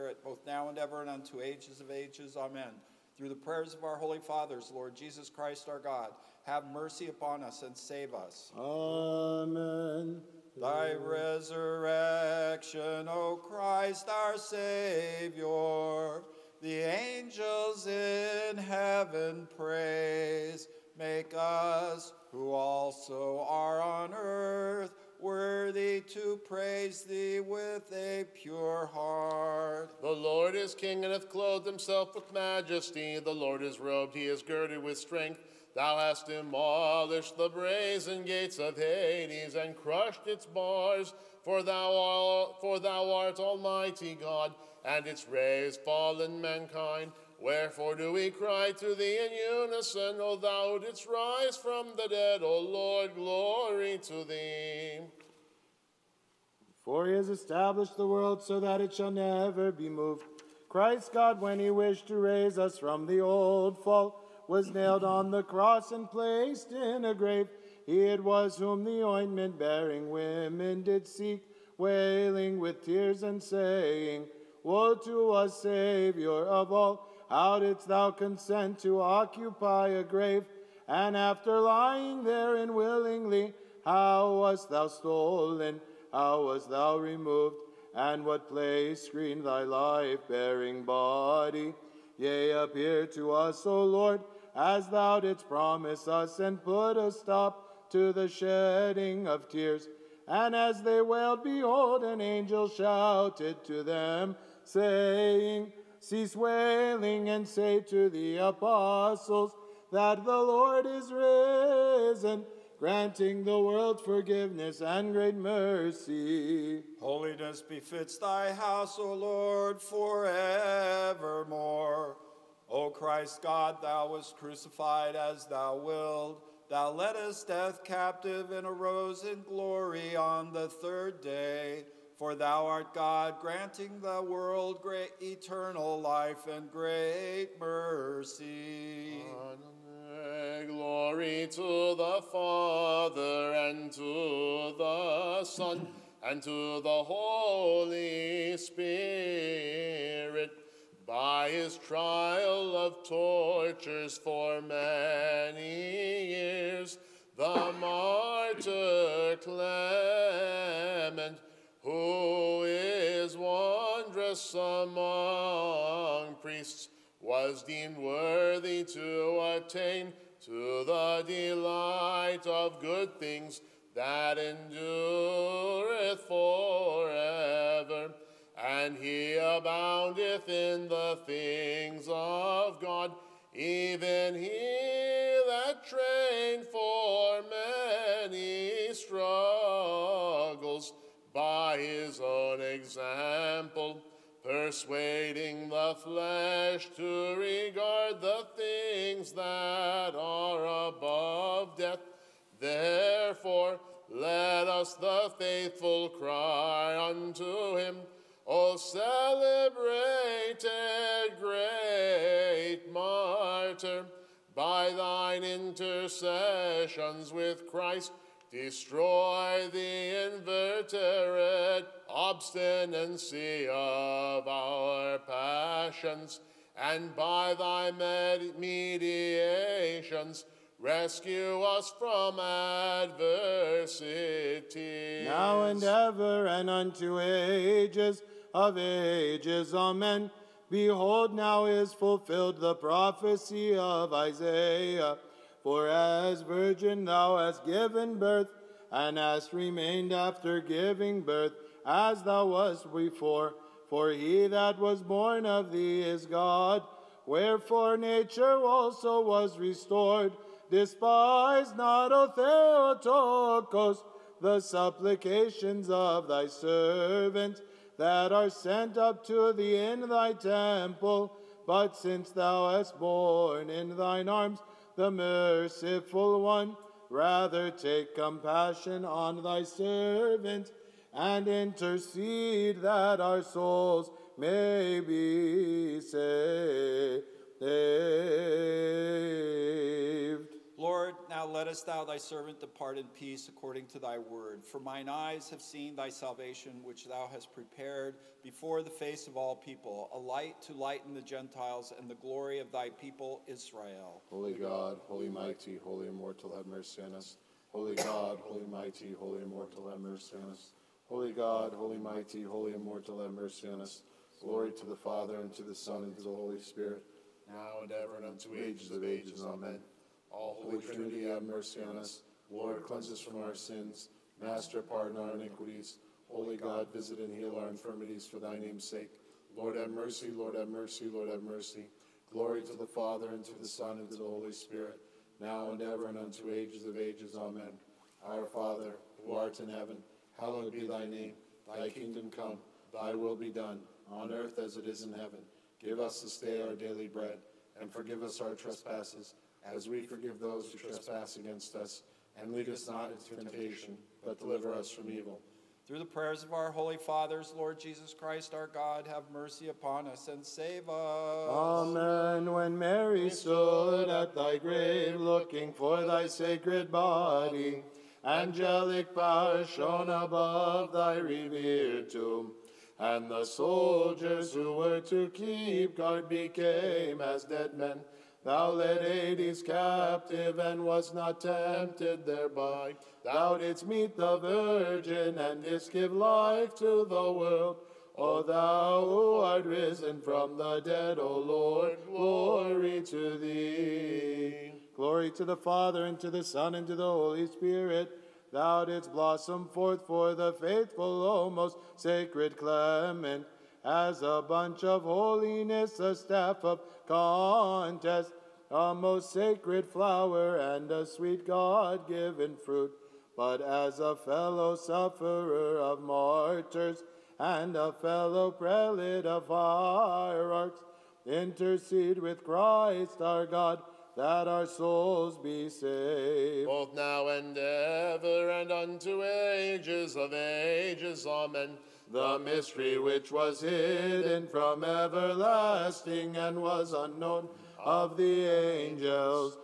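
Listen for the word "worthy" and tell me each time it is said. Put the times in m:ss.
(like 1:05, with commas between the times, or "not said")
0:25, 2:47.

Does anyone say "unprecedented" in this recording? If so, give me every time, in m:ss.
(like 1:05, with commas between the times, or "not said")
not said.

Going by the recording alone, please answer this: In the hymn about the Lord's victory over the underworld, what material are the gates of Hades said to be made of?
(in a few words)
brazen.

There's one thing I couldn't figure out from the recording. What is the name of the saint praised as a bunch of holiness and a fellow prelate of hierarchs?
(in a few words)
Clement.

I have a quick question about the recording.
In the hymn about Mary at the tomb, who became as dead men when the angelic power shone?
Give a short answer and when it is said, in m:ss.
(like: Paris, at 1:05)
the soldiers, at 6:13.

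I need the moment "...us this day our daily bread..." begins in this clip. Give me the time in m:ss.
5:45.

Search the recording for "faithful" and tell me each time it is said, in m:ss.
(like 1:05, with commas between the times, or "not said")
3:25, 6:40.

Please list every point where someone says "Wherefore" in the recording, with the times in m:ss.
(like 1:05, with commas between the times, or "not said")
0:47, 4:17.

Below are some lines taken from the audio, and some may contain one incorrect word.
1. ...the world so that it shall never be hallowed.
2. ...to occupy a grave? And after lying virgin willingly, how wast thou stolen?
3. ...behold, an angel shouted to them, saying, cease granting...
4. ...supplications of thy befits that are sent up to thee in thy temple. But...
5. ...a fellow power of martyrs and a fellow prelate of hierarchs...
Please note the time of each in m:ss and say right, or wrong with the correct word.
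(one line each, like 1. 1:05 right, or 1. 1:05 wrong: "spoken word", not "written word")
1. 0:57 wrong: "moved", not "hallowed"
2. 1:18 wrong: "therein", not "virgin"
3. 1:41 wrong: "wailing", not "granting"
4. 4:24 wrong: "servants", not "befits"
5. 6:53 wrong: "sufferer", not "power".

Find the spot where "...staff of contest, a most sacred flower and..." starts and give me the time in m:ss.
6:46.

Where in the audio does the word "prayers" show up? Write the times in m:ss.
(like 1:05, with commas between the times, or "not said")
0:03, 5:56.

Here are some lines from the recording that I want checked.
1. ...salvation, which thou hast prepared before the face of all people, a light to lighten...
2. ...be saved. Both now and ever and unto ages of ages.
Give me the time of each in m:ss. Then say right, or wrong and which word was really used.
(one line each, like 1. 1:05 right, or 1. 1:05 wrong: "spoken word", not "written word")
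1. 4:56 right
2. 7:05 right.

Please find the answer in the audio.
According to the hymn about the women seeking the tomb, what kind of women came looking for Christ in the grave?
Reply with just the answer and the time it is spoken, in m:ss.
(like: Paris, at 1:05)
ointment bearing women, at 1:09.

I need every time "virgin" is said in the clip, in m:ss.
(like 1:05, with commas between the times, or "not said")
4:06, 6:24.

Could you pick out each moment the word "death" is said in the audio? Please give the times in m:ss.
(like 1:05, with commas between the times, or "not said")
2:07, 3:21.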